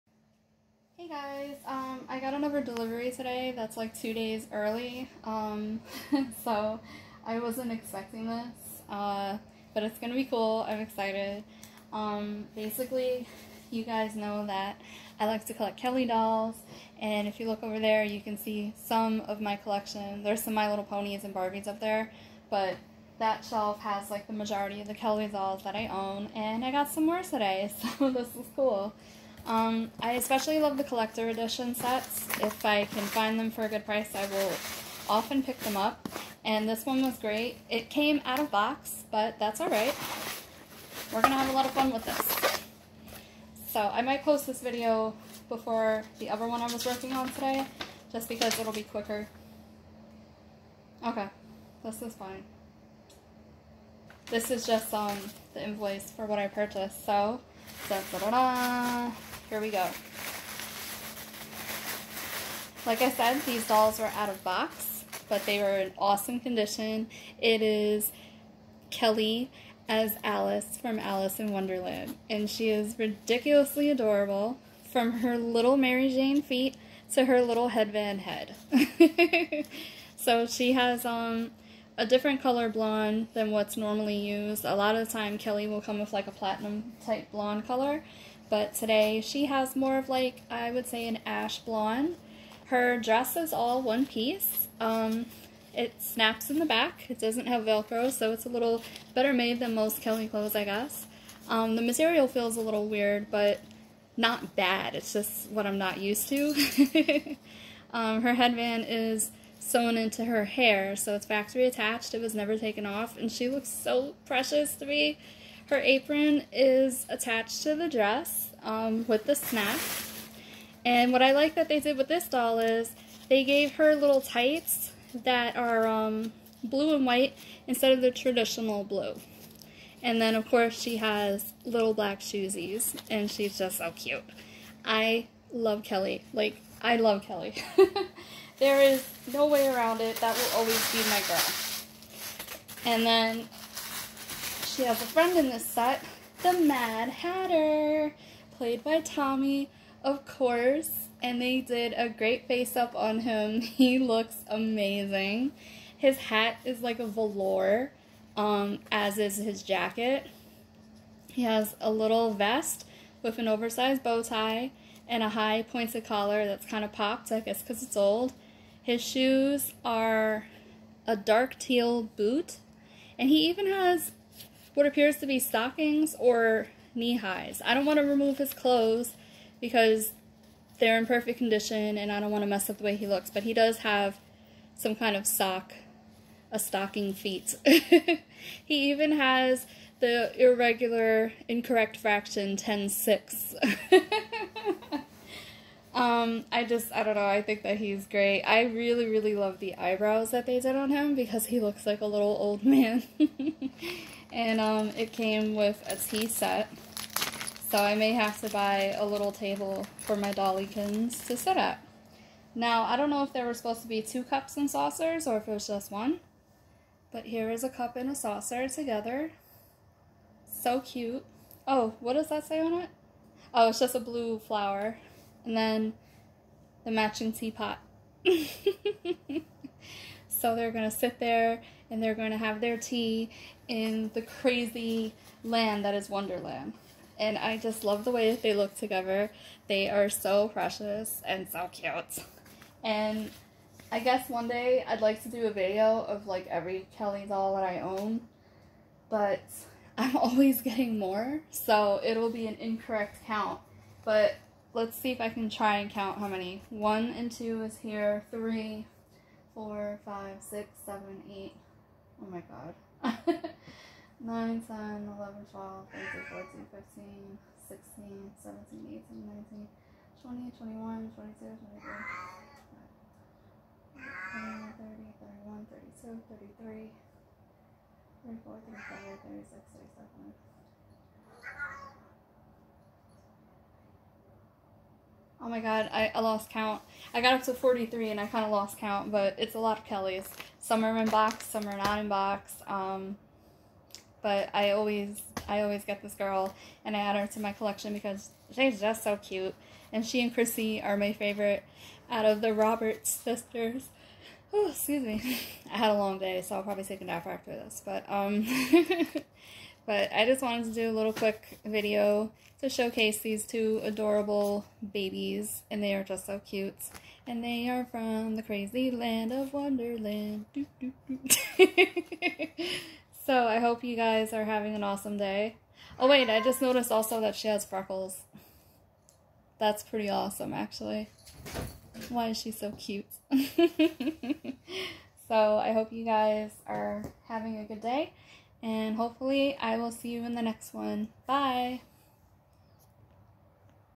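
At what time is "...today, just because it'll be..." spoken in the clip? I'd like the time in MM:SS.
00:47.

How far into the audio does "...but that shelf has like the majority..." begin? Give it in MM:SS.
00:22.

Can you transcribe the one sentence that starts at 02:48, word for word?
His shoes are a dark teal boot, and he even has what appears to be stockings or knee highs.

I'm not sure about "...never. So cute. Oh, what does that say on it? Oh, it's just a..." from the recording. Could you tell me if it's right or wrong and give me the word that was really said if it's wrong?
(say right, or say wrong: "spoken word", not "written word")
wrong: "together", not "never".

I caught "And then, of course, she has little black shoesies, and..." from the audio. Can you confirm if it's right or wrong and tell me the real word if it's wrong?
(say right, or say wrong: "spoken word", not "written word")
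right.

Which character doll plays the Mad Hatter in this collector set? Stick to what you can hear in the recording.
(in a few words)
Tommy.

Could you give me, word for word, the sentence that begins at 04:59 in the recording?
And she and Chrissy are my favorite out of the Roberts sisters.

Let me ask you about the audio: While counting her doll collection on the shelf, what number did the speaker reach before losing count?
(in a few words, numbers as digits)
43.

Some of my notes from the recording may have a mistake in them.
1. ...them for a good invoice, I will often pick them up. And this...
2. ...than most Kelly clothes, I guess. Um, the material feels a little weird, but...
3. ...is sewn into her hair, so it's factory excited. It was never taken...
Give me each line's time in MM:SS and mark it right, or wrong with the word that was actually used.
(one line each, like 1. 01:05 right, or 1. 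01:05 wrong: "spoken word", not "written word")
1. 00:33 wrong: "price", not "invoice"
2. 01:39 right
3. 01:48 wrong: "attached", not "excited".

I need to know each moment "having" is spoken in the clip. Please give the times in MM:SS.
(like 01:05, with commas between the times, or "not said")
05:24, 05:37.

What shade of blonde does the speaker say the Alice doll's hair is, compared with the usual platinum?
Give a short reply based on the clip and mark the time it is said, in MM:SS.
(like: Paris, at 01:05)
ash blonde, at 01:31.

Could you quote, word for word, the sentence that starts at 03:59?
They are so precious and so cute.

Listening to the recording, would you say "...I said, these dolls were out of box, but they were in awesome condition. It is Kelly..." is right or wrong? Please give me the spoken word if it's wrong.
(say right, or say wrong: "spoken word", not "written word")
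right.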